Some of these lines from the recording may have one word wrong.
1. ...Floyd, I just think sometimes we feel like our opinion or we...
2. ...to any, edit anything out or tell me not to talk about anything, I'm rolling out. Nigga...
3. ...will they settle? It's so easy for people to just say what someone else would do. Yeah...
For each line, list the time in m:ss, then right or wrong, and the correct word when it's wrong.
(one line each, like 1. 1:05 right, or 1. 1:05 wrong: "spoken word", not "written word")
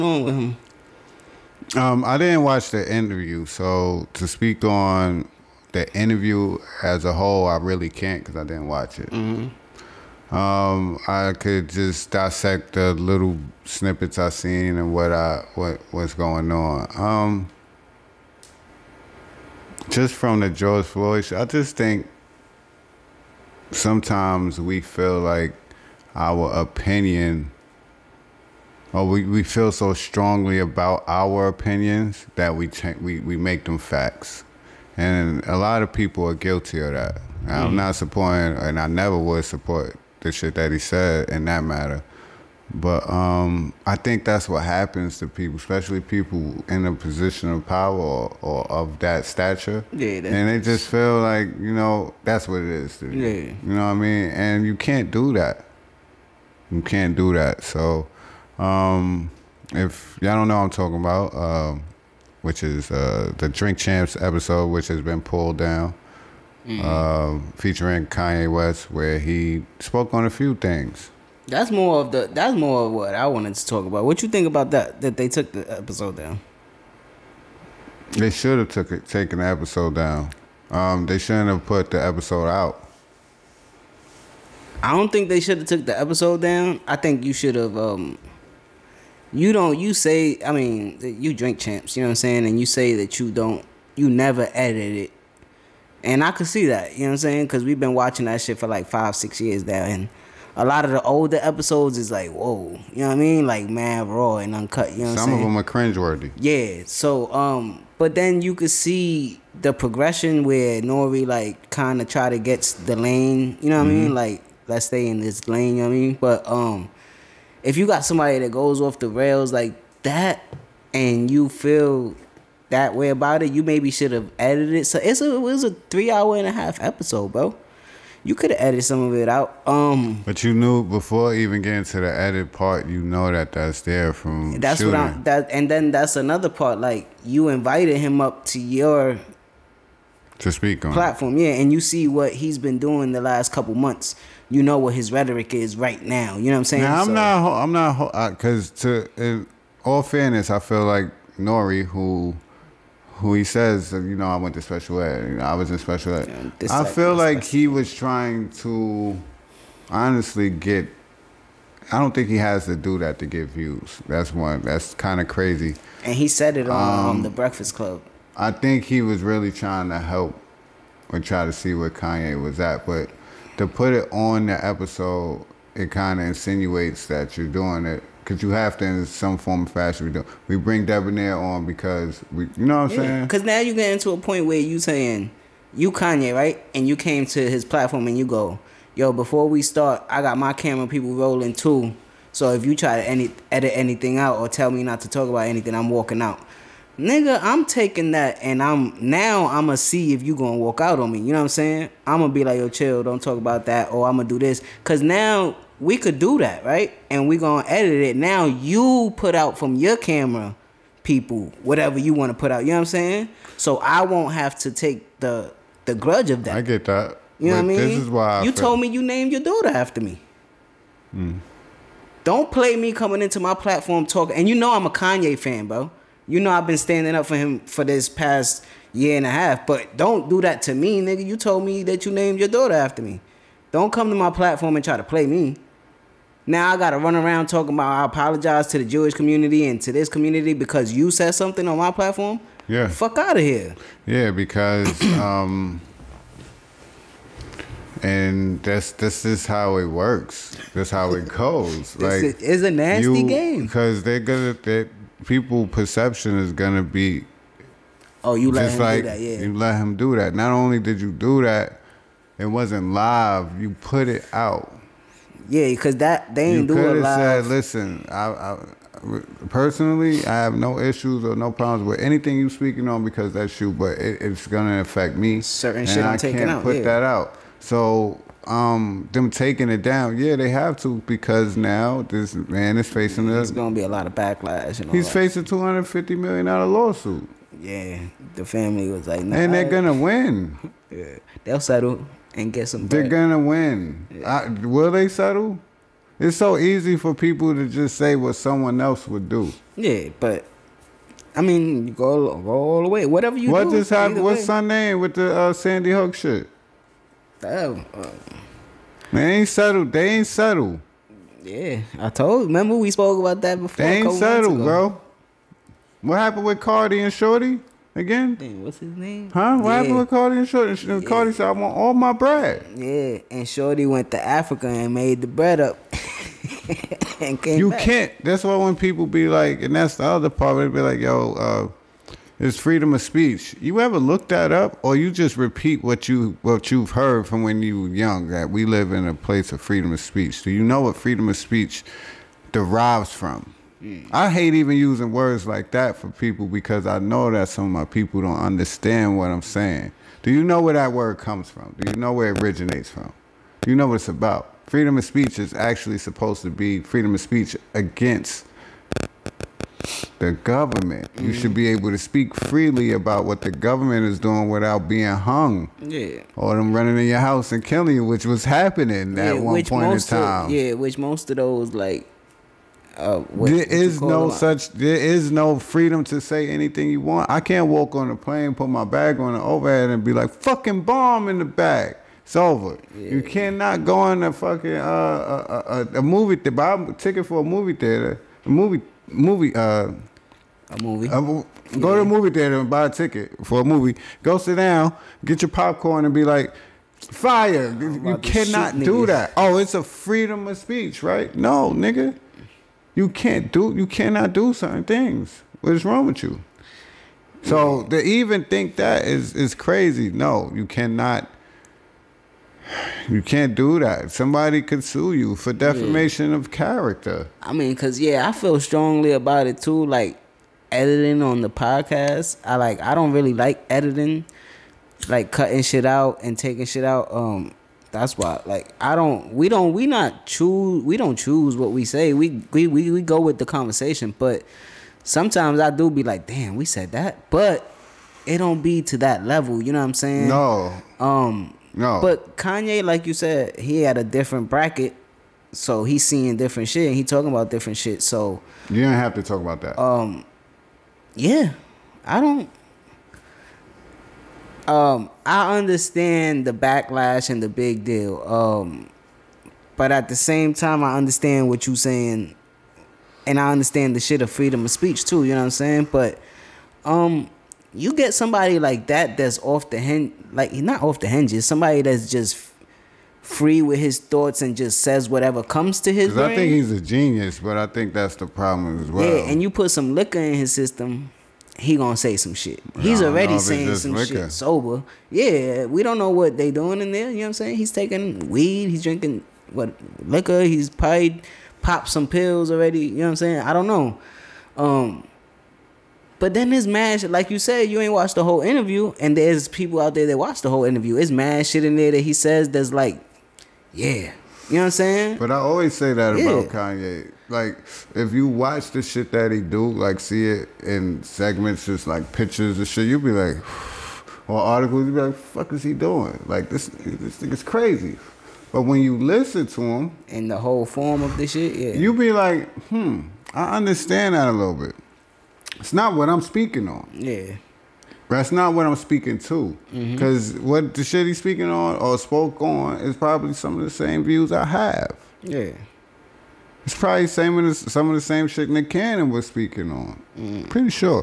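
1. 0:20 right
2. 3:12 wrong: "walking", not "rolling"
3. 4:54 right.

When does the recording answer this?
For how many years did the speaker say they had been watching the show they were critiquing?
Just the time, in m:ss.
1:38.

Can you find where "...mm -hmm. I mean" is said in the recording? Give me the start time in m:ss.
1:53.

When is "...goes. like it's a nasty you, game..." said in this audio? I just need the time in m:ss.
4:11.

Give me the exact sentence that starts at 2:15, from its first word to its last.
That and then that's another part.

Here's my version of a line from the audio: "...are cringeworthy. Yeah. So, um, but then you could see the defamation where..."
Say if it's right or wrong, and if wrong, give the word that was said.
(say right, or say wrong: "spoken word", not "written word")
wrong: "progression", not "defamation".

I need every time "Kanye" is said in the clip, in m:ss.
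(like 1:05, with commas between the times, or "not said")
1:08, 2:51, 3:05, 3:44, 7:22, 8:26.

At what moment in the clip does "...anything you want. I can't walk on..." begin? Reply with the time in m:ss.
6:16.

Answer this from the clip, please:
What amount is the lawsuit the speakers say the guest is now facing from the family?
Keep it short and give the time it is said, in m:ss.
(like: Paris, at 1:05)
$250 million, at 4:45.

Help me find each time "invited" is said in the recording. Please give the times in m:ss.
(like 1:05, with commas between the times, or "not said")
2:17.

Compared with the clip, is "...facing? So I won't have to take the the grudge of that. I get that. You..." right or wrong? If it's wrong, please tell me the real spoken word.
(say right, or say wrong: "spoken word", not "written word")
wrong: "saying", not "facing".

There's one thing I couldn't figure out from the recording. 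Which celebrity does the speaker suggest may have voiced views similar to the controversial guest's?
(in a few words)
Nick Cannon.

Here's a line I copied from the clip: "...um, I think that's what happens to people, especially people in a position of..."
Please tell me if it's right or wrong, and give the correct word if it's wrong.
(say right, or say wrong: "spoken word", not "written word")
right.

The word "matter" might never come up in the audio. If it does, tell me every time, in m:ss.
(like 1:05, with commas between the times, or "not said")
0:41.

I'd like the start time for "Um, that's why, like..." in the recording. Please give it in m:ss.
7:07.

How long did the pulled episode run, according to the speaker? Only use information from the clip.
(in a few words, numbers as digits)
3 and a half hours.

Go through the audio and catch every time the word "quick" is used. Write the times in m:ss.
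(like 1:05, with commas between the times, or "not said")
not said.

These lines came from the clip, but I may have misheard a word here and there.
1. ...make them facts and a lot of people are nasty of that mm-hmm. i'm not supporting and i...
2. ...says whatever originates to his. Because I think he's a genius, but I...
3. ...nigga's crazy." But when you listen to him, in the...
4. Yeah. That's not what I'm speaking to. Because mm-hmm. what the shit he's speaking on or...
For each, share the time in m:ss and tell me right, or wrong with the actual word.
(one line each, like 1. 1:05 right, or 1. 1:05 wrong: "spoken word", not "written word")
1. 0:33 wrong: "guilty", not "nasty"
2. 7:54 wrong: "comes", not "originates"
3. 8:37 right
4. 8:46 right.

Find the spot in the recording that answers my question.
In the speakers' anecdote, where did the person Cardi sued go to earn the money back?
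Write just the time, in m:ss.
5:24.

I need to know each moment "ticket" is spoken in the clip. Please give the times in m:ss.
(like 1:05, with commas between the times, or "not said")
6:26, 6:32.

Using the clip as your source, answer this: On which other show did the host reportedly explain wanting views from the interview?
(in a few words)
The Breakfast Club.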